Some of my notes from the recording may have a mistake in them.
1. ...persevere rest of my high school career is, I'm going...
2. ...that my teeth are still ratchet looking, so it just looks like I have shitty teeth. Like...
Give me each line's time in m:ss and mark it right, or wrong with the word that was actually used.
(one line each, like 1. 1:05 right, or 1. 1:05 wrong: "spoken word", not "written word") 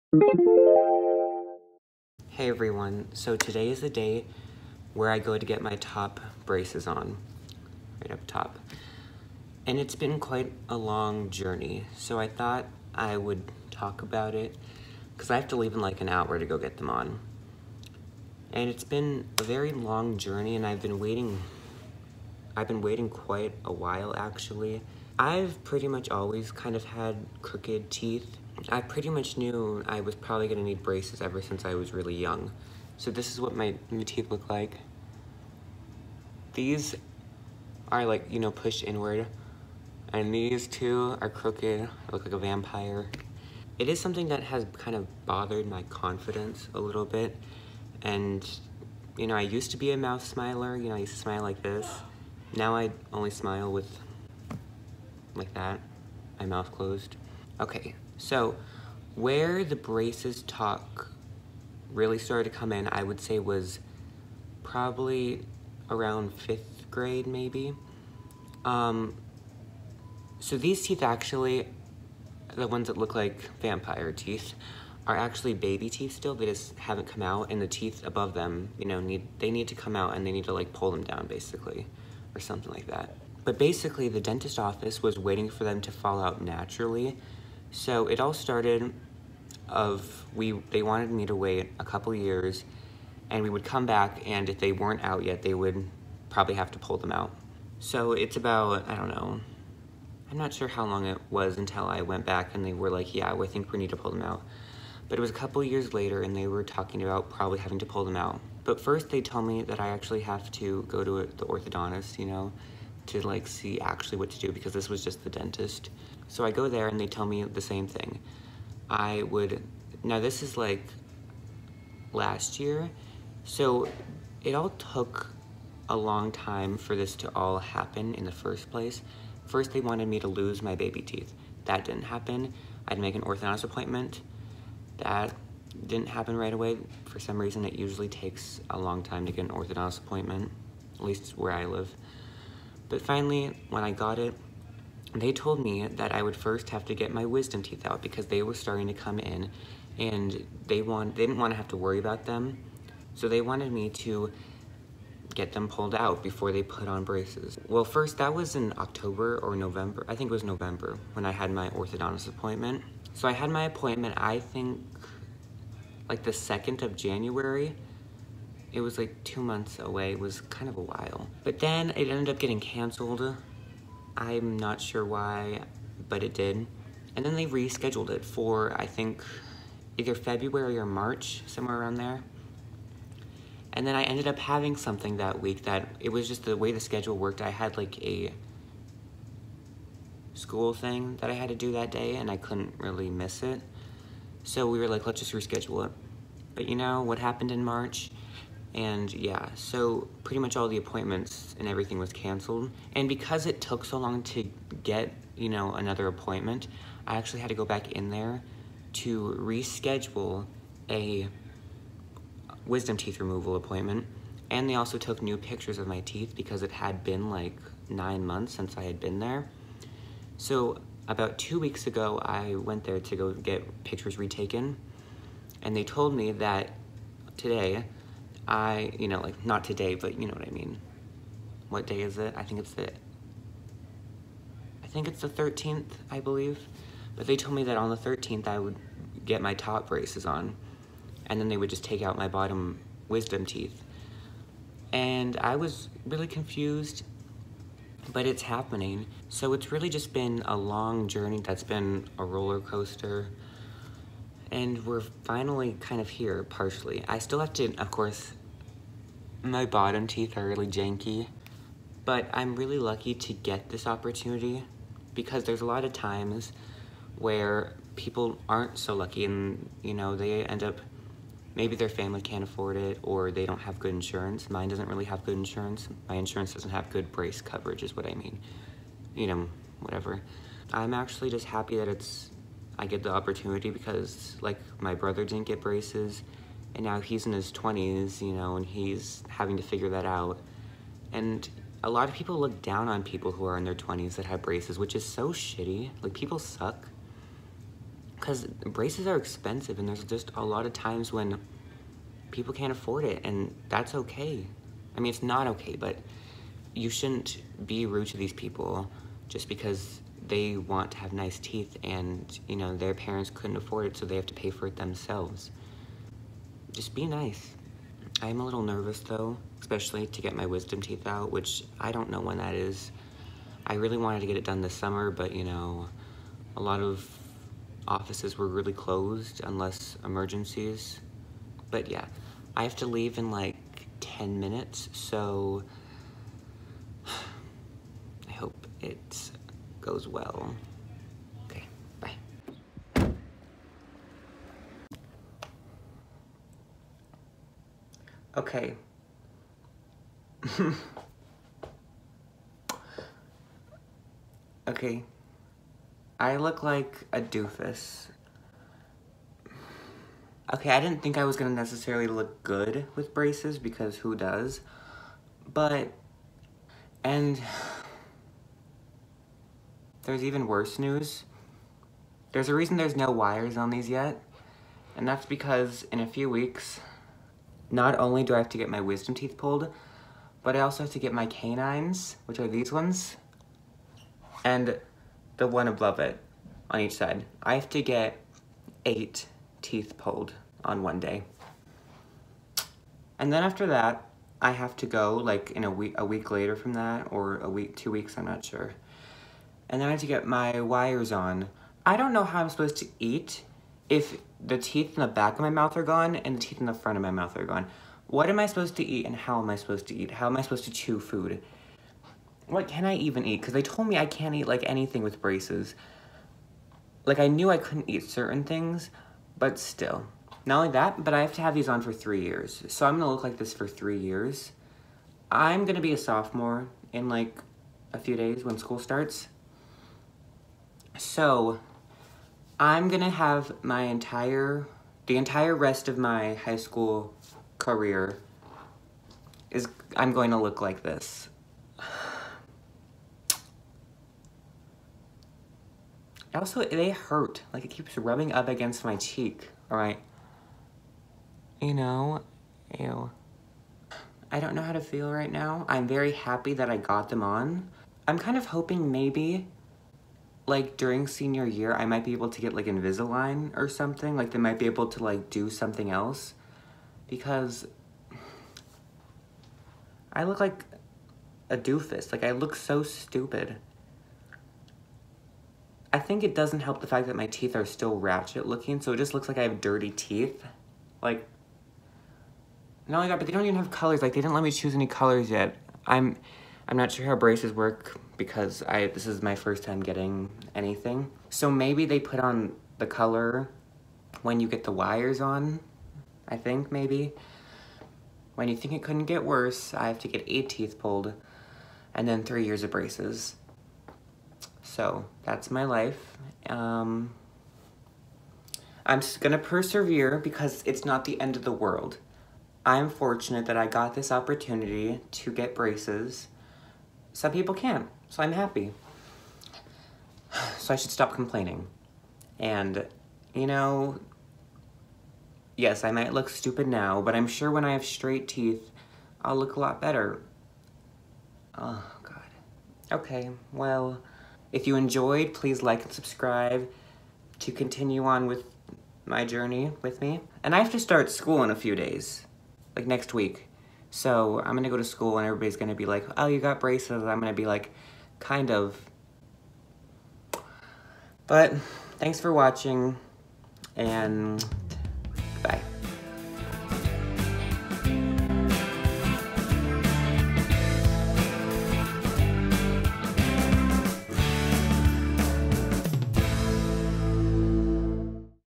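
1. 7:15 wrong: "entire", not "persevere"
2. 7:57 wrong: "dirty", not "shitty".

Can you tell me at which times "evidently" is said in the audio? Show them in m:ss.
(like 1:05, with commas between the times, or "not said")
not said.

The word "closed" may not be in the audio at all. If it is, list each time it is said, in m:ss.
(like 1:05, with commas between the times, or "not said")
0:56, 5:28.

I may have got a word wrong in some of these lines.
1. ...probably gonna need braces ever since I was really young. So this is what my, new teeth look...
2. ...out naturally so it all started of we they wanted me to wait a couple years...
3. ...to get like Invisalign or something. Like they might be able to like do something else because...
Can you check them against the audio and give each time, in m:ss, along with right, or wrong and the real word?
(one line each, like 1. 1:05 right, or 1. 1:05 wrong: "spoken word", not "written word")
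1. 0:30 right
2. 1:26 right
3. 7:42 right.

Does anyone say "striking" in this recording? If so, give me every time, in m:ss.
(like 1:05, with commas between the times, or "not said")
not said.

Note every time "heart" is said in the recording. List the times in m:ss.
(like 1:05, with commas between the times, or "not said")
not said.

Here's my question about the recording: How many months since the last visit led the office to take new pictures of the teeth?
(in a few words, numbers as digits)
9.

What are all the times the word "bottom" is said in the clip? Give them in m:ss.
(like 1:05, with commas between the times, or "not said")
4:02, 4:19.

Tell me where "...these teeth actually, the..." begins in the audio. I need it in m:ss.
1:10.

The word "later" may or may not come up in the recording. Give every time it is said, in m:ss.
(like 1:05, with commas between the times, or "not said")
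1:45, 6:36.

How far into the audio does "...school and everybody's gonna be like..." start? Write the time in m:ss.
9:04.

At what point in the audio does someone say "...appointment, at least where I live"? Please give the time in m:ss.
2:19.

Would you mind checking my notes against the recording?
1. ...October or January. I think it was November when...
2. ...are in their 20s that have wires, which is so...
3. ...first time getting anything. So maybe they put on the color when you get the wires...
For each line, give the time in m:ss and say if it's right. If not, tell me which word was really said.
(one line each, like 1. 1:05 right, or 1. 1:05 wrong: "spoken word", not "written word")
1. 2:38 wrong: "November", not "January"
2. 4:53 wrong: "braces", not "wires"
3. 8:09 right.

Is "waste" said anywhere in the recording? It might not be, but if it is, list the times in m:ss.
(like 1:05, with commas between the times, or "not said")
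not said.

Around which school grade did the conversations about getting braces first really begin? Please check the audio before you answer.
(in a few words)
Fifth grade.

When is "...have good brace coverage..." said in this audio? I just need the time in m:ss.
4:36.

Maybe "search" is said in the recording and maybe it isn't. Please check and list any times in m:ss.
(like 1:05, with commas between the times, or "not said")
not said.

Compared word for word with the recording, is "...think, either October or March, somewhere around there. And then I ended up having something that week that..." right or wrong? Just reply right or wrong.
wrong.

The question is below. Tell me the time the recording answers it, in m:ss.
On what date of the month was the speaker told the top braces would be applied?
3:57.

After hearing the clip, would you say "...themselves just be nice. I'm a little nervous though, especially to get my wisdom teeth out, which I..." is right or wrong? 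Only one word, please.
right.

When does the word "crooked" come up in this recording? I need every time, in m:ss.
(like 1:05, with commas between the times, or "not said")
0:27, 0:41.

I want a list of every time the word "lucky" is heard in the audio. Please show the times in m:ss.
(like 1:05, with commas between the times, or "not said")
4:22, 4:28.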